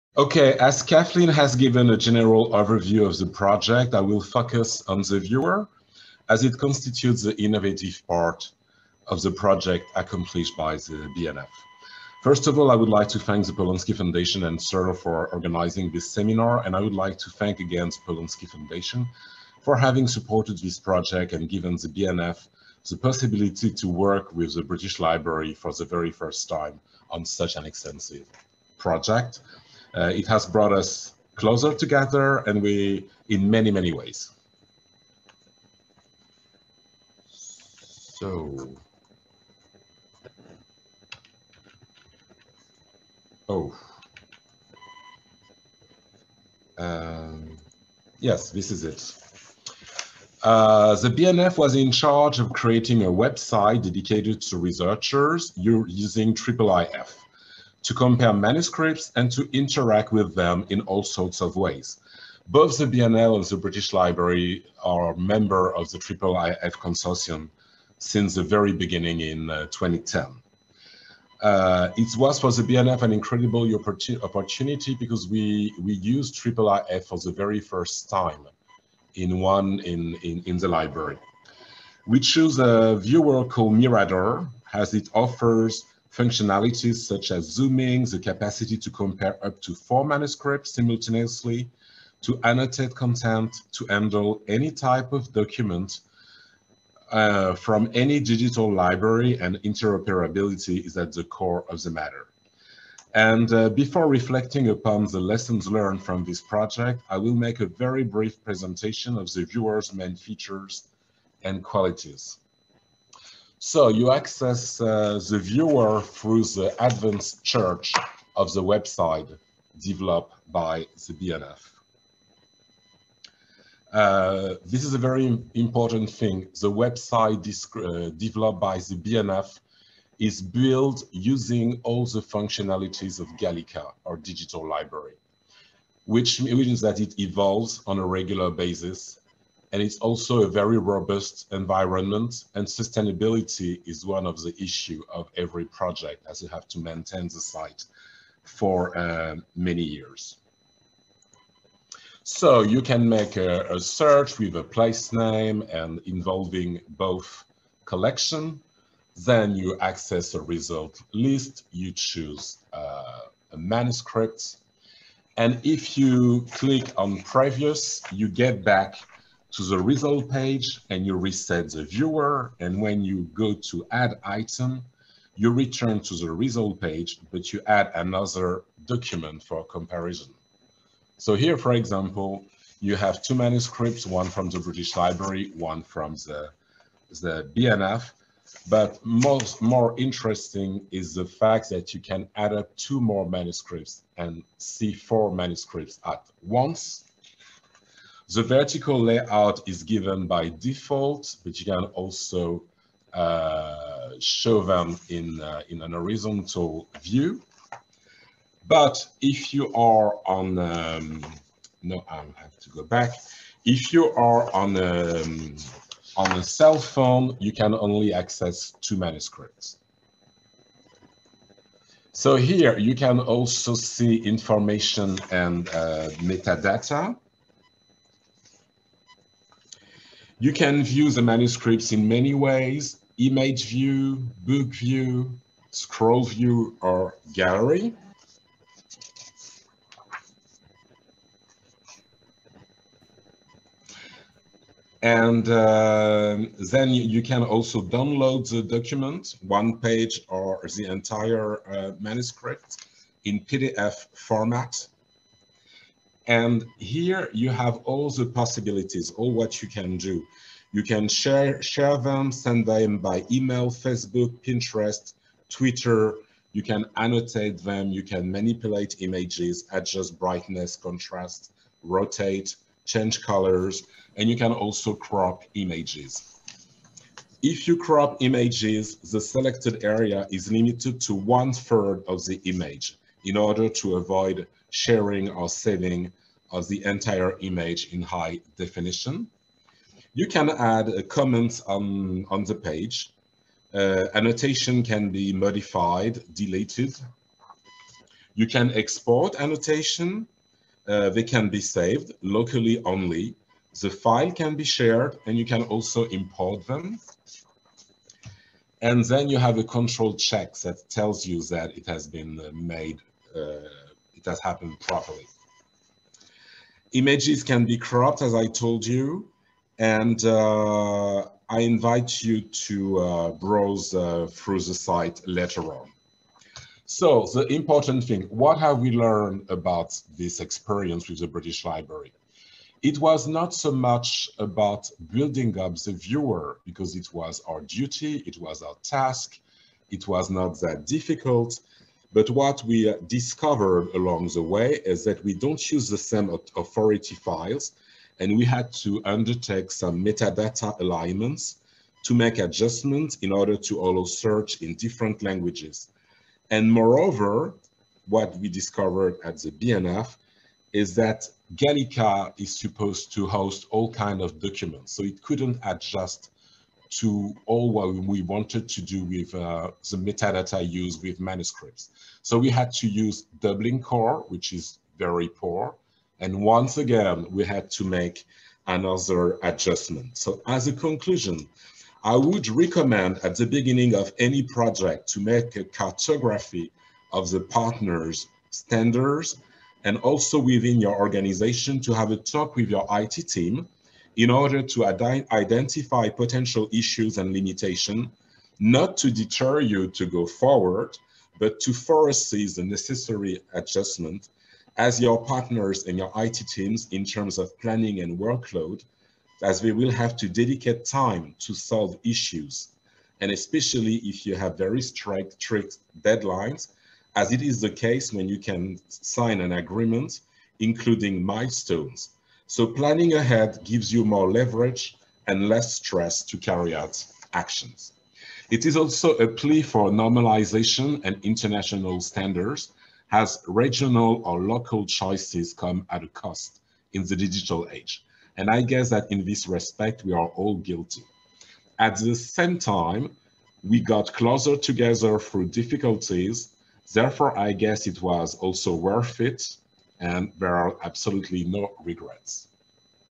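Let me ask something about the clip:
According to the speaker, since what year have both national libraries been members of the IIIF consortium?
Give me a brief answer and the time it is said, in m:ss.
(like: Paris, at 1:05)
2010, at 1:09.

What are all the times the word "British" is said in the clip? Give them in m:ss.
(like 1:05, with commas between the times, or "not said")
0:24, 1:03, 3:04, 5:31.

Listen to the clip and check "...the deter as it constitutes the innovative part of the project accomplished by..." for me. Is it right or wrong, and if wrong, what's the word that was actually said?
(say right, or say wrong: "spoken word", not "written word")
wrong: "viewer", not "deter".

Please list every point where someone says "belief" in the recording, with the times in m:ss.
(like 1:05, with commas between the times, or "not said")
not said.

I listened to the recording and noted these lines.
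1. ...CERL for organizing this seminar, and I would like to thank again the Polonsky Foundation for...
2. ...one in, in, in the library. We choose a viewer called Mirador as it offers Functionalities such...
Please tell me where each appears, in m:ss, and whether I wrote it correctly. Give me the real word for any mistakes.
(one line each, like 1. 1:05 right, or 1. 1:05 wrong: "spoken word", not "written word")
1. 0:14 right
2. 1:19 right.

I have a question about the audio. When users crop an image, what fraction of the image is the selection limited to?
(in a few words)
One third.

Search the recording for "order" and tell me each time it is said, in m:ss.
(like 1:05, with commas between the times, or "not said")
4:43, 5:53, 6:34.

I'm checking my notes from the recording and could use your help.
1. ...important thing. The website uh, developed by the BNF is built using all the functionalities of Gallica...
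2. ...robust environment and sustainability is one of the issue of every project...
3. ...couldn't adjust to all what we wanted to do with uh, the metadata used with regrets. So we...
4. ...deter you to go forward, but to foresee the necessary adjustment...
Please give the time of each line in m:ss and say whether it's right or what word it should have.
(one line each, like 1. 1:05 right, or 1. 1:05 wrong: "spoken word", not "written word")
1. 2:05 right
2. 2:20 right
3. 6:05 wrong: "manuscripts", not "regrets"
4. 6:39 right.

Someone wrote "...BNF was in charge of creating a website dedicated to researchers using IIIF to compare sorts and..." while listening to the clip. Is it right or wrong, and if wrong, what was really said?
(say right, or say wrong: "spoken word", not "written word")
wrong: "manuscripts", not "sorts".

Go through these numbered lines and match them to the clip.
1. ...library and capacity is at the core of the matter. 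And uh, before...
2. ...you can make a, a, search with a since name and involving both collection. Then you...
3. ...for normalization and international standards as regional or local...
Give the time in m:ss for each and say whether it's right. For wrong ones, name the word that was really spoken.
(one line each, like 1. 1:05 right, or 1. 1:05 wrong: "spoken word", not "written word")
1. 1:38 wrong: "interoperability", not "capacity"
2. 2:32 wrong: "place", not "since"
3. 7:09 right.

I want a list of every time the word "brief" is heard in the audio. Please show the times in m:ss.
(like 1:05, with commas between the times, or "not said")
1:48.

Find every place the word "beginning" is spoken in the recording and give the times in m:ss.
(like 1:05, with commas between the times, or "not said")
1:08, 6:23.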